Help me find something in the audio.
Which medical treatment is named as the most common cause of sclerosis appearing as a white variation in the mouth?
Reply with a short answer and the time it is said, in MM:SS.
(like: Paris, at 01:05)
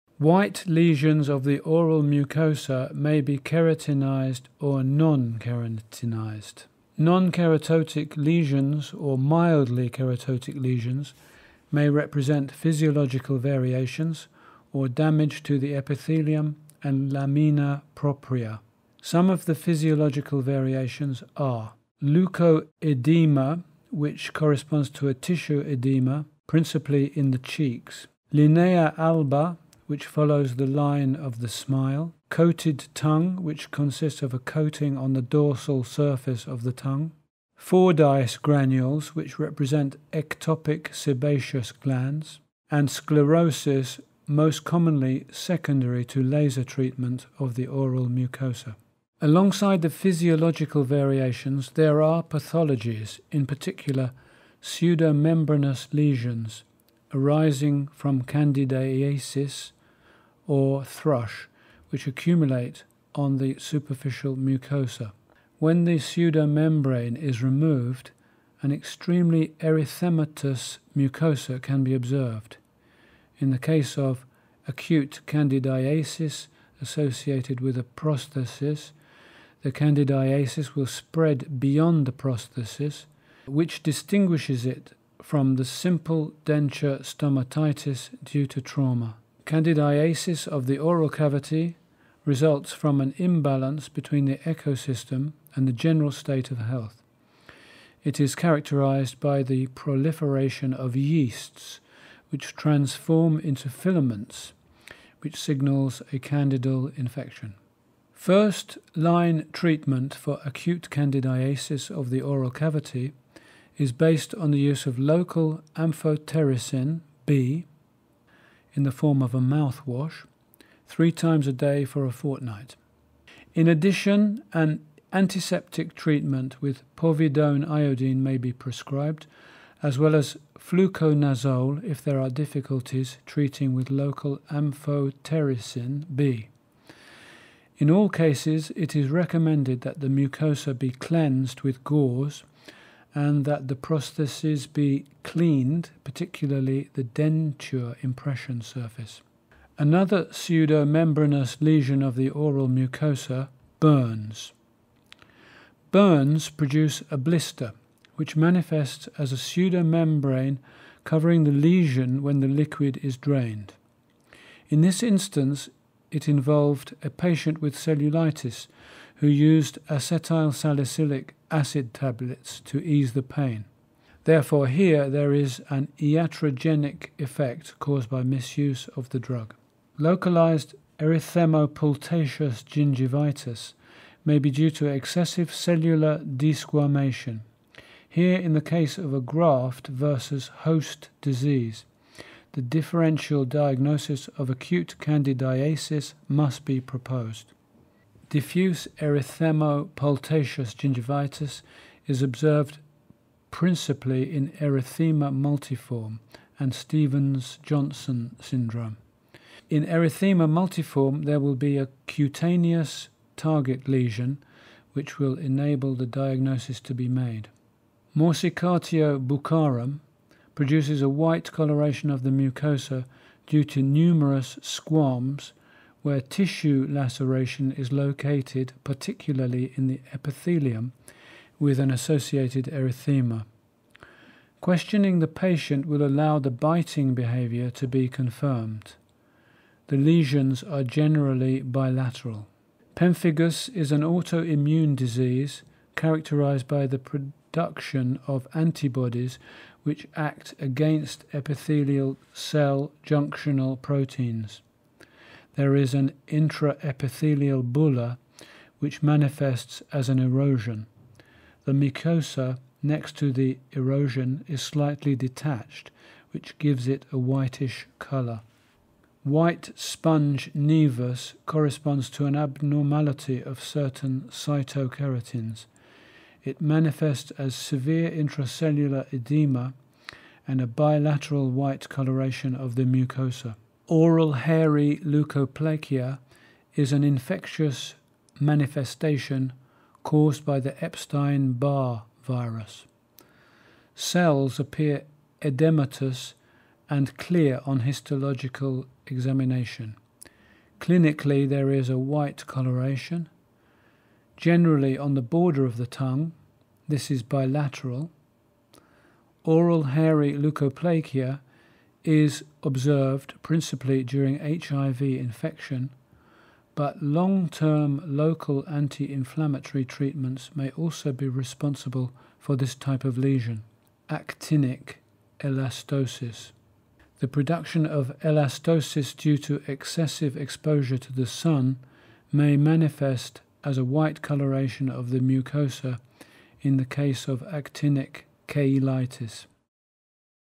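Laser treatment, at 00:46.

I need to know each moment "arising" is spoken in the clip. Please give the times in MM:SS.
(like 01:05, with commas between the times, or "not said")
00:57.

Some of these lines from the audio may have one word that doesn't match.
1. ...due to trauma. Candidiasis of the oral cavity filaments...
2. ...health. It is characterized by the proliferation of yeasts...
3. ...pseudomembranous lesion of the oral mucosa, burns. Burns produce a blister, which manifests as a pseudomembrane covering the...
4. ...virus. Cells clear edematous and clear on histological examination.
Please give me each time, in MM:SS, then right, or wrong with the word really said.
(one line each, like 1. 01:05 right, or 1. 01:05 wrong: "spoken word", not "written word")
1. 01:28 wrong: "results", not "filaments"
2. 01:36 right
3. 02:30 right
4. 04:52 wrong: "appear", not "clear".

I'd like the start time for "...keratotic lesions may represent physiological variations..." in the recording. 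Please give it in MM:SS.
00:09.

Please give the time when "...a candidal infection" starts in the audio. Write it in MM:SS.
01:46.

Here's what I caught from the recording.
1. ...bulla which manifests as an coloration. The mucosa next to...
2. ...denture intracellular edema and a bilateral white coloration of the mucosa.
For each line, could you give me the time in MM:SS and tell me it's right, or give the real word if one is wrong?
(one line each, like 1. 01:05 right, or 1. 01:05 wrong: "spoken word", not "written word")
1. 04:17 wrong: "erosion", not "coloration"
2. 04:37 wrong: "severe", not "denture".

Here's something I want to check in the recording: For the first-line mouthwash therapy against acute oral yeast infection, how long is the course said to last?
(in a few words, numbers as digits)
A fortnight.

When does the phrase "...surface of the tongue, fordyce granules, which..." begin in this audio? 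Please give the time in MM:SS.
00:35.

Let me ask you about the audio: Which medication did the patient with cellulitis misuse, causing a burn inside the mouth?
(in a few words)
Acetyl salicylic acid.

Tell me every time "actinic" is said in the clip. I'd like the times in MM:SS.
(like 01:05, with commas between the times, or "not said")
05:24, 05:37.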